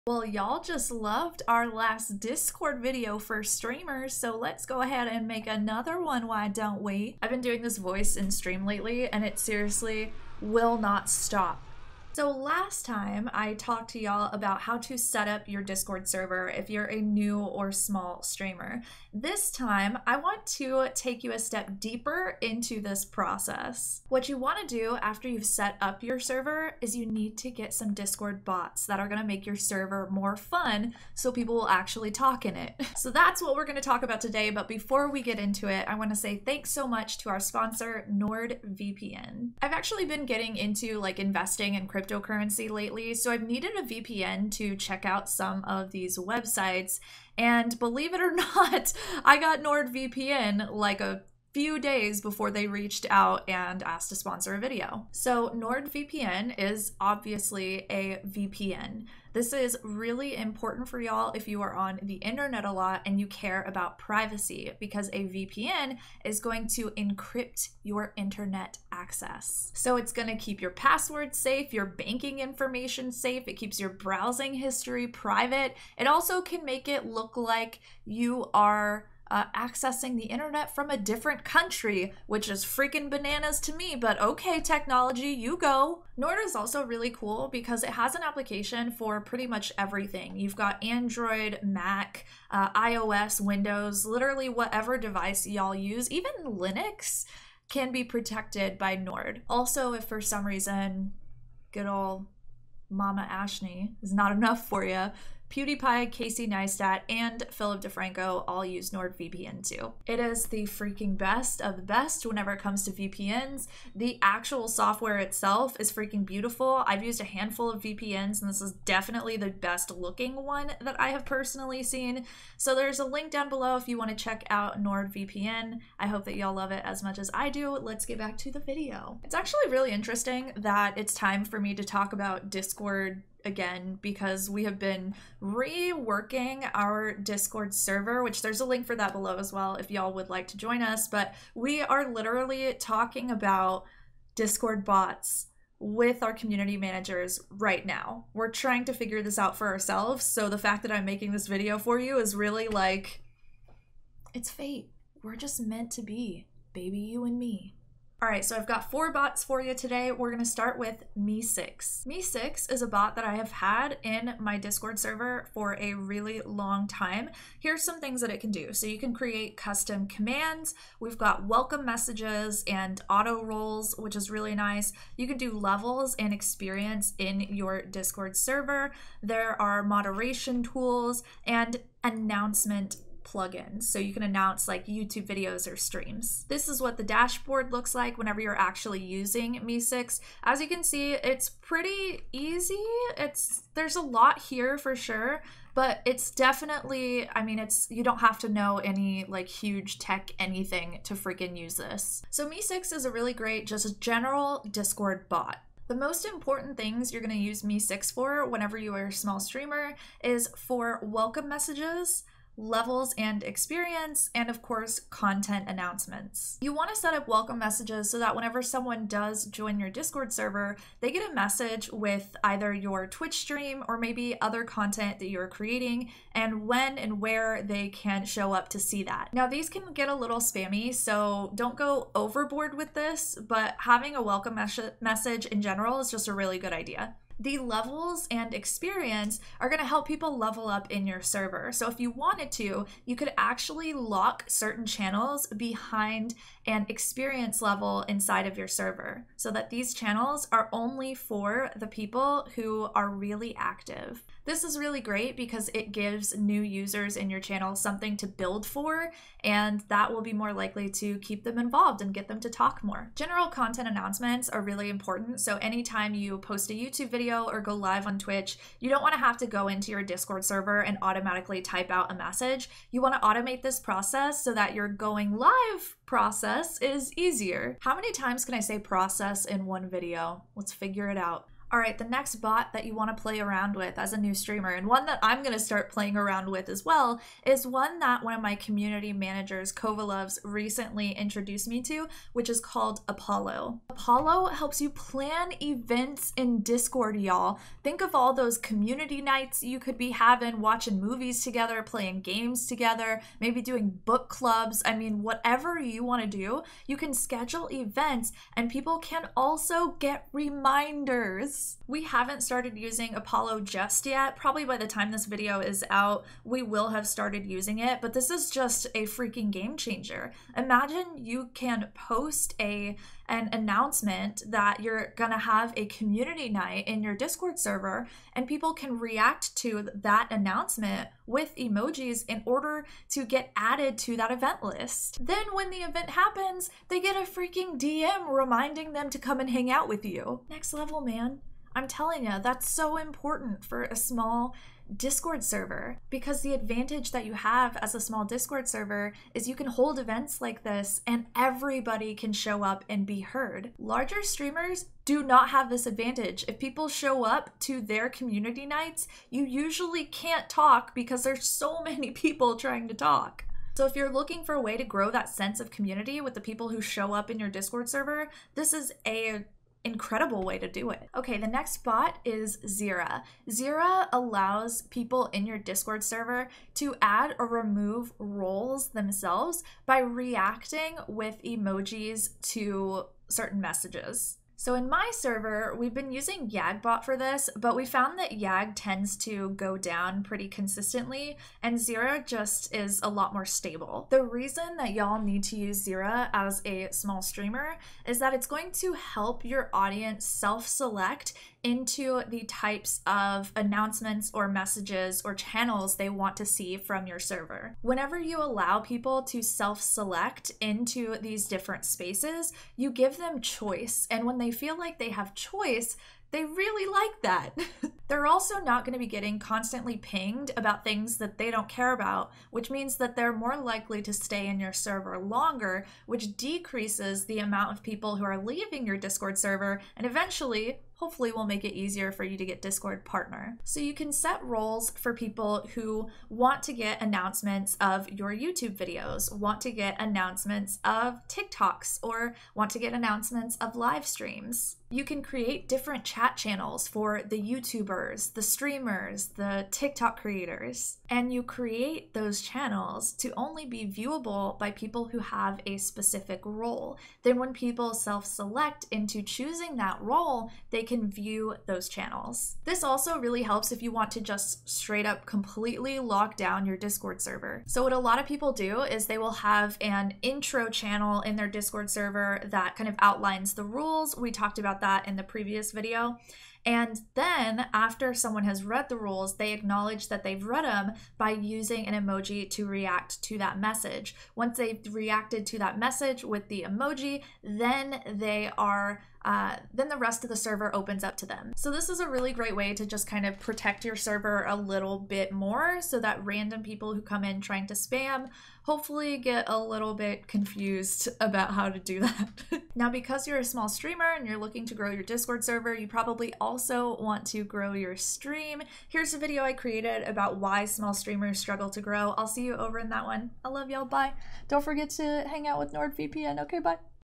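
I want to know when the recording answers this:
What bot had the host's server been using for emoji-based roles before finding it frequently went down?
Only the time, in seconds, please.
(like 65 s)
386 s.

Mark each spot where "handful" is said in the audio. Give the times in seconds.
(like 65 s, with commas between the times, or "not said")
117 s.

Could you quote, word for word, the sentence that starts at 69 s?
So it's going to keep your password safe, your banking information safe, it keeps your browsing history private.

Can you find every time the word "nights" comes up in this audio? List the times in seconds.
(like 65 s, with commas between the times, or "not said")
299 s, 326 s, 358 s.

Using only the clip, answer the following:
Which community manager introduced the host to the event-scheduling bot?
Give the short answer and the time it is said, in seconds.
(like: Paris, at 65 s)
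Kovalovs, at 289 s.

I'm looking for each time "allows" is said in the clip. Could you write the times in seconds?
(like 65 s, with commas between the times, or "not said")
374 s, 408 s.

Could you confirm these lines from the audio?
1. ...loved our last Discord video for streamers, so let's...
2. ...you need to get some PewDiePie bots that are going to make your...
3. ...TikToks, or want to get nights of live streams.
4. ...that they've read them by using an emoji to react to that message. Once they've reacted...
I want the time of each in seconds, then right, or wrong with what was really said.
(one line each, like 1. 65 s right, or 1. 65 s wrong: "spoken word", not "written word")
1. 0 s right
2. 26 s wrong: "Discord", not "PewDiePie"
3. 441 s wrong: "announcements", not "nights"
4. 480 s right.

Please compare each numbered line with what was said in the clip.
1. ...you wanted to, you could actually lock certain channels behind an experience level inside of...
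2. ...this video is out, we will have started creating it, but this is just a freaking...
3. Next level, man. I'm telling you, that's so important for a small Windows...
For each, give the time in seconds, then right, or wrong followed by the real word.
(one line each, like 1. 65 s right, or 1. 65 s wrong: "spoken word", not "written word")
1. 241 s right
2. 315 s wrong: "using", not "creating"
3. 340 s wrong: "Discord", not "Windows".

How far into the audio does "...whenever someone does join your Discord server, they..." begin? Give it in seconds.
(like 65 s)
218 s.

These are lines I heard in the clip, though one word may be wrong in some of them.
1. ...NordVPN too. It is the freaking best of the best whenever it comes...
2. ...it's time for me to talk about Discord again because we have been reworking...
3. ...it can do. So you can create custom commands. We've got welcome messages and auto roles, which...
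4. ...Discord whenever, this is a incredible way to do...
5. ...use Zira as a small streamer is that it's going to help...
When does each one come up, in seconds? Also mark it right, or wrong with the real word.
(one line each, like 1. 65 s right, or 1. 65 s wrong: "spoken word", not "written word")
1. 108 s right
2. 130 s right
3. 168 s right
4. 367 s wrong: "server", not "whenever"
5. 395 s right.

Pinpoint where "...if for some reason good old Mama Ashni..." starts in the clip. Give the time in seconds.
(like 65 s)
99 s.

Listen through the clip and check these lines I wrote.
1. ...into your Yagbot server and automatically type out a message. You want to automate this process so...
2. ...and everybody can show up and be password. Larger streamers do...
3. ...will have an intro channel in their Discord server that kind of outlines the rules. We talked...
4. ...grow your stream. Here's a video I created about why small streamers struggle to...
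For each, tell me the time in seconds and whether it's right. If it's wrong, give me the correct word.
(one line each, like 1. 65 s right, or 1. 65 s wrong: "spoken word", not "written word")
1. 269 s wrong: "Discord", not "Yagbot"
2. 351 s wrong: "heard", not "password"
3. 469 s right
4. 507 s right.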